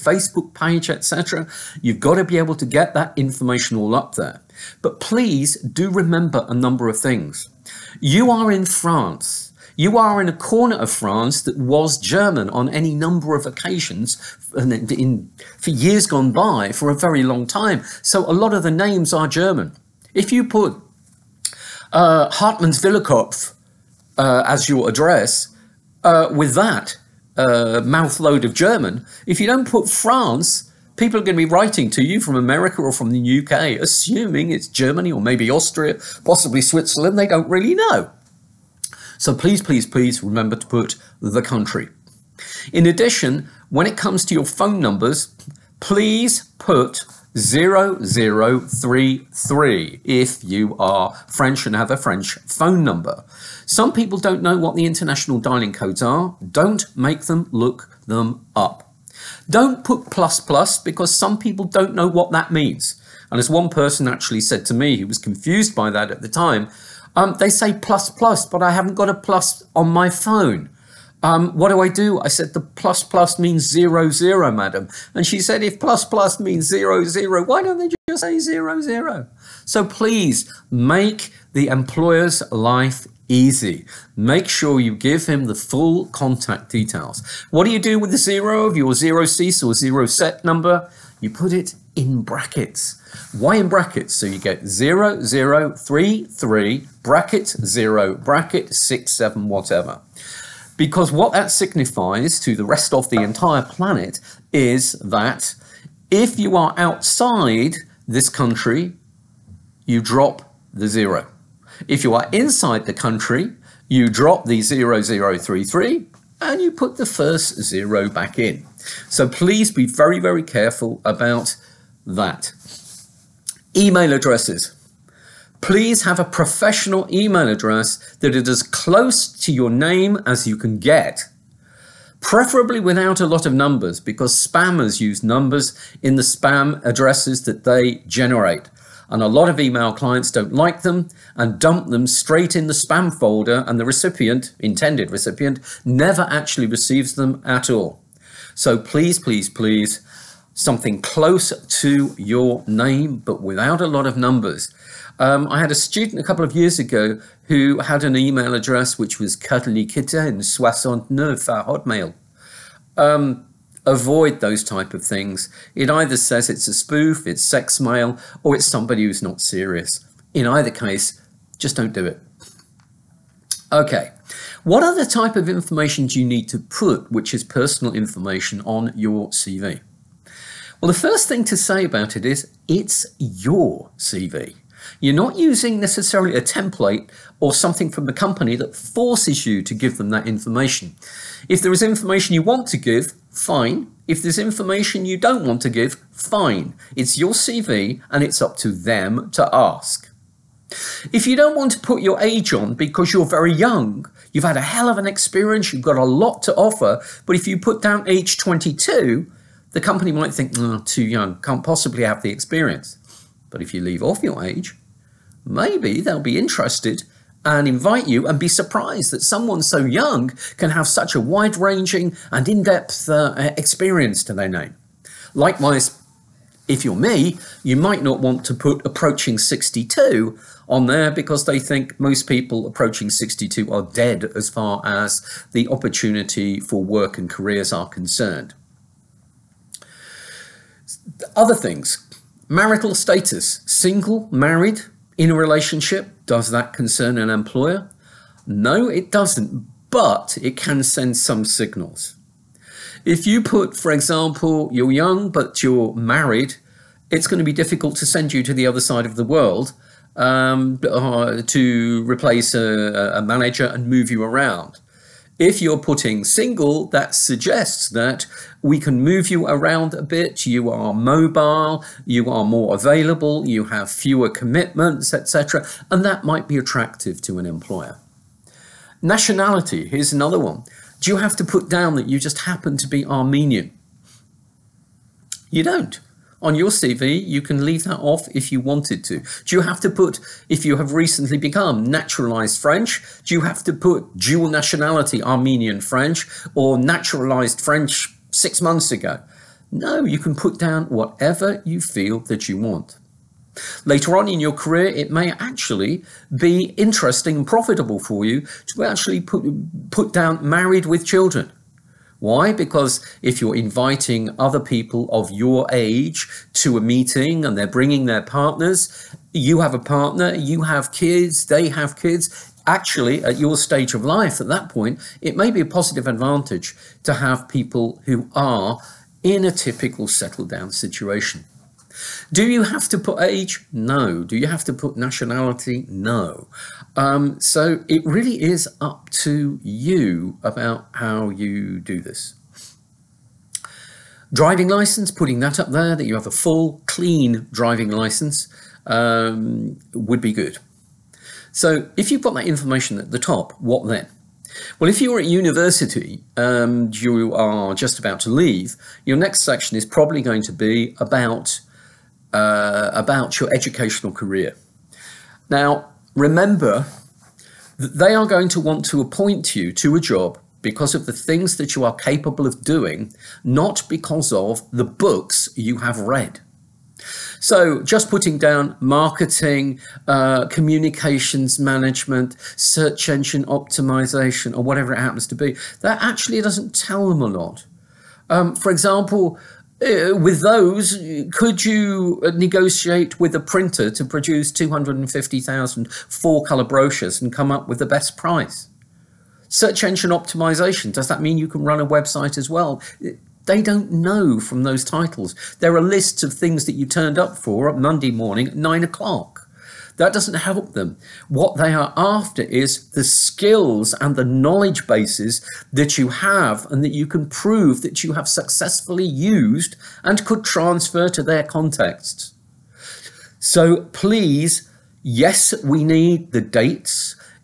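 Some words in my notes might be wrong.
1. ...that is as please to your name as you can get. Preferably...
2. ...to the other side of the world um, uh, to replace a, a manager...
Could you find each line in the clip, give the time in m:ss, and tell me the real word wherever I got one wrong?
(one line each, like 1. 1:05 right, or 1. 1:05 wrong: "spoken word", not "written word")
1. 2:08 wrong: "close", not "please"
2. 4:18 right.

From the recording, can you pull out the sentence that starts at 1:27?
What do you do with the zero of your zero cease or zero set number?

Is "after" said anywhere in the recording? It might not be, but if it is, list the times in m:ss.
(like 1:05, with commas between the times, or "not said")
6:51.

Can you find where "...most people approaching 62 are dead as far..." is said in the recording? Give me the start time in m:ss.
3:51.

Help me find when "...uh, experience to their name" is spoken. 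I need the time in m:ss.
3:43.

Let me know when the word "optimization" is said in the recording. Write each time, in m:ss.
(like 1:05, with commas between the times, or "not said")
6:23, 6:40.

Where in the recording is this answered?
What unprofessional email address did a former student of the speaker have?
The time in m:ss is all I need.
2:39.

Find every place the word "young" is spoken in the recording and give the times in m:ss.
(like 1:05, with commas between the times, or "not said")
3:23, 3:31, 3:39, 4:14.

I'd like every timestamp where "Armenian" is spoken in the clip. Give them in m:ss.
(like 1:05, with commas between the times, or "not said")
4:43, 4:55.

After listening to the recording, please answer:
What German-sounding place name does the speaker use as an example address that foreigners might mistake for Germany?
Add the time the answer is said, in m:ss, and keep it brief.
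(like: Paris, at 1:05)
Hartmannswillerkopf, at 0:22.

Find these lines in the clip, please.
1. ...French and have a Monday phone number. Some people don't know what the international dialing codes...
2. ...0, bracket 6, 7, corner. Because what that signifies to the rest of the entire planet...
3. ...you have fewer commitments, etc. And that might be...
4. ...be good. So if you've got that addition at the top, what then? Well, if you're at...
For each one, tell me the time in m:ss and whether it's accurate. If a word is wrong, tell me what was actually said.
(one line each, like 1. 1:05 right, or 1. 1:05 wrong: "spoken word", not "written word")
1. 0:51 wrong: "French", not "Monday"
2. 1:37 wrong: "whatever", not "corner"
3. 4:33 right
4. 5:50 wrong: "information", not "addition".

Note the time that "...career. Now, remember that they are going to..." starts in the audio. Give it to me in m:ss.
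6:04.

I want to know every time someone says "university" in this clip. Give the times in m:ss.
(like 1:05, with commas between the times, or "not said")
5:55.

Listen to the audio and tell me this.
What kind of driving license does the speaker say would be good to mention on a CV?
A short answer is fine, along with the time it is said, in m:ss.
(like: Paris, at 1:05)
full, clean driving license, at 5:46.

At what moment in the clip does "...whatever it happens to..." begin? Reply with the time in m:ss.
6:24.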